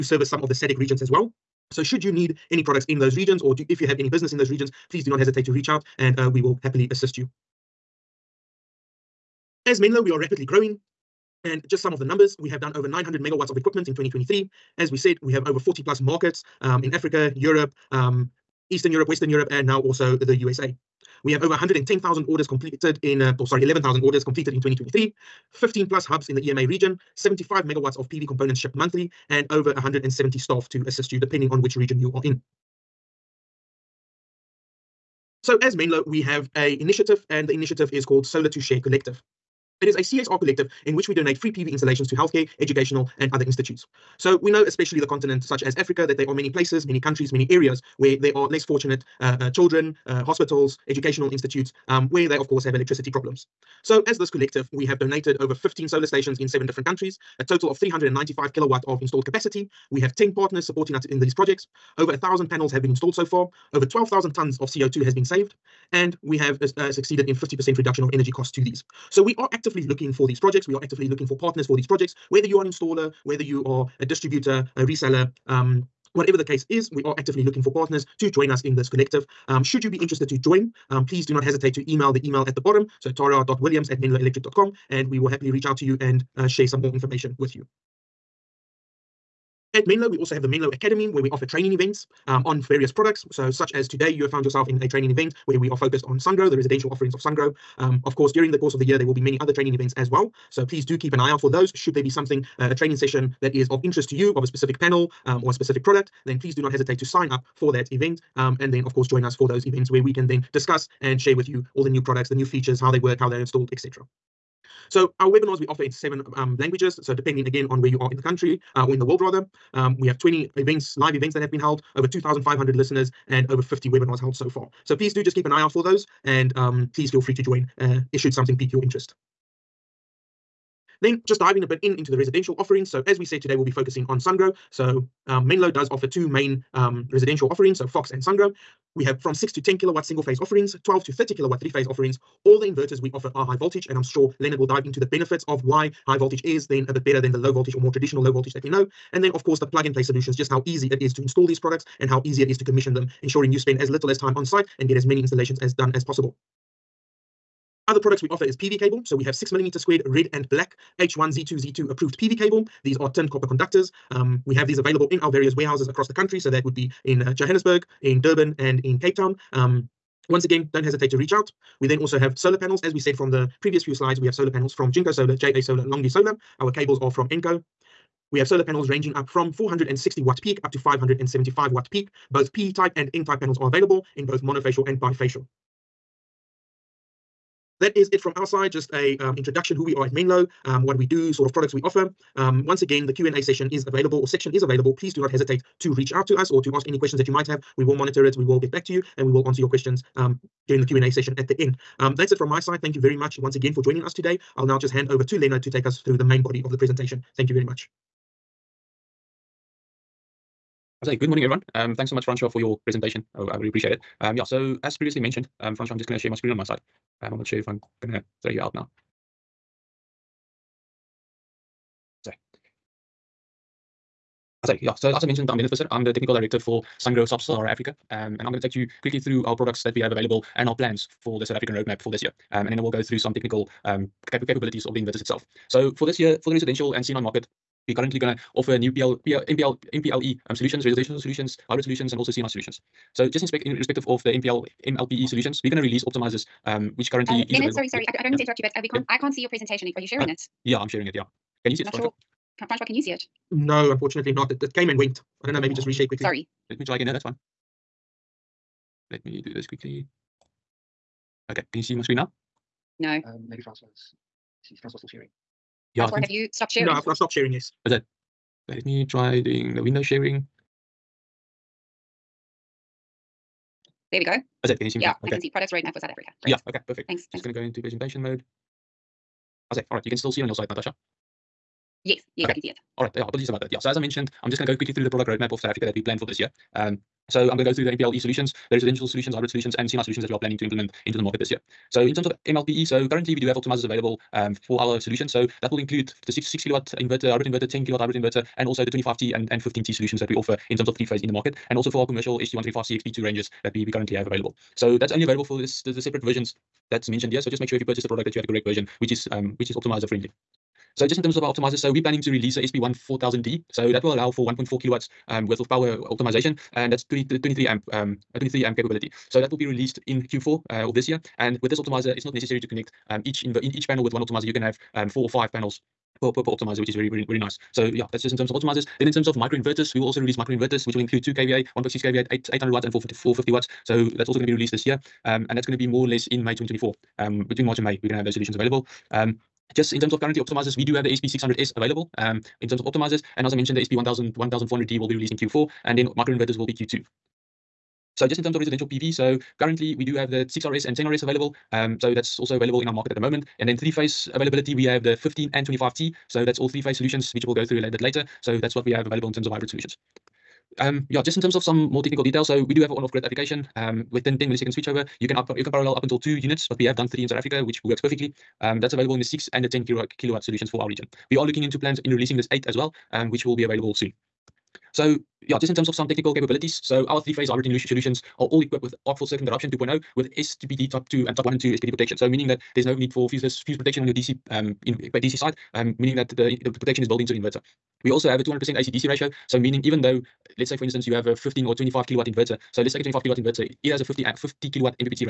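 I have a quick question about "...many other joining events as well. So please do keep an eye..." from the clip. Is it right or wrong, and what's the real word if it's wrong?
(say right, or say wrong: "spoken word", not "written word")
wrong: "training", not "joining".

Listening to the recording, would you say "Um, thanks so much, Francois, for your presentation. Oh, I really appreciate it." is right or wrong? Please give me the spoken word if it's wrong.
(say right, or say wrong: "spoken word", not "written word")
right.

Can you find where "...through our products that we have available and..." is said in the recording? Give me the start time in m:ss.
3:49.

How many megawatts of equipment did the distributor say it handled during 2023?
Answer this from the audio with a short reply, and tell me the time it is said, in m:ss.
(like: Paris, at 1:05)
900 megawatts, at 0:12.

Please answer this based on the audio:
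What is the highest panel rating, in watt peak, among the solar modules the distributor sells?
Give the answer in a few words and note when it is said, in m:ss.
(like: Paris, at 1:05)
575 watt peak, at 3:00.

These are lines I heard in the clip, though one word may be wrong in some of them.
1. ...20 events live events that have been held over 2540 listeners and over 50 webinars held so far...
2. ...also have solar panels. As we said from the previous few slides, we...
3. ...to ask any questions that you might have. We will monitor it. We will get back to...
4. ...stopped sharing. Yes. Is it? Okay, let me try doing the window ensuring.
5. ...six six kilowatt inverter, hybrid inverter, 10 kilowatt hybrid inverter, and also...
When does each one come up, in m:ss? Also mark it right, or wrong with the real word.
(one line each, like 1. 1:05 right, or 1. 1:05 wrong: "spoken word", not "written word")
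1. 2:00 wrong: "2500", not "2540"
2. 2:51 right
3. 3:16 right
4. 4:27 wrong: "sharing", not "ensuring"
5. 4:56 right.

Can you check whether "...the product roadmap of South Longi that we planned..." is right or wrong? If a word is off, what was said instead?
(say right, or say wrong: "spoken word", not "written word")
wrong: "Africa", not "Longi".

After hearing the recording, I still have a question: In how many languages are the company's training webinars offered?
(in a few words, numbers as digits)
7.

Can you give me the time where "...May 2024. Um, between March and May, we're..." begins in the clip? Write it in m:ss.
5:36.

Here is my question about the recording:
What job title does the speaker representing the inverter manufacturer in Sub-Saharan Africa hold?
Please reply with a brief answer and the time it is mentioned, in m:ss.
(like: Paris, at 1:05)
technical director, at 3:46.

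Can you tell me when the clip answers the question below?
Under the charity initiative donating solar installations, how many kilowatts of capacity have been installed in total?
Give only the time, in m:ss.
0:57.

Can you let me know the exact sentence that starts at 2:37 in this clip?
Other products we offer is PV cable.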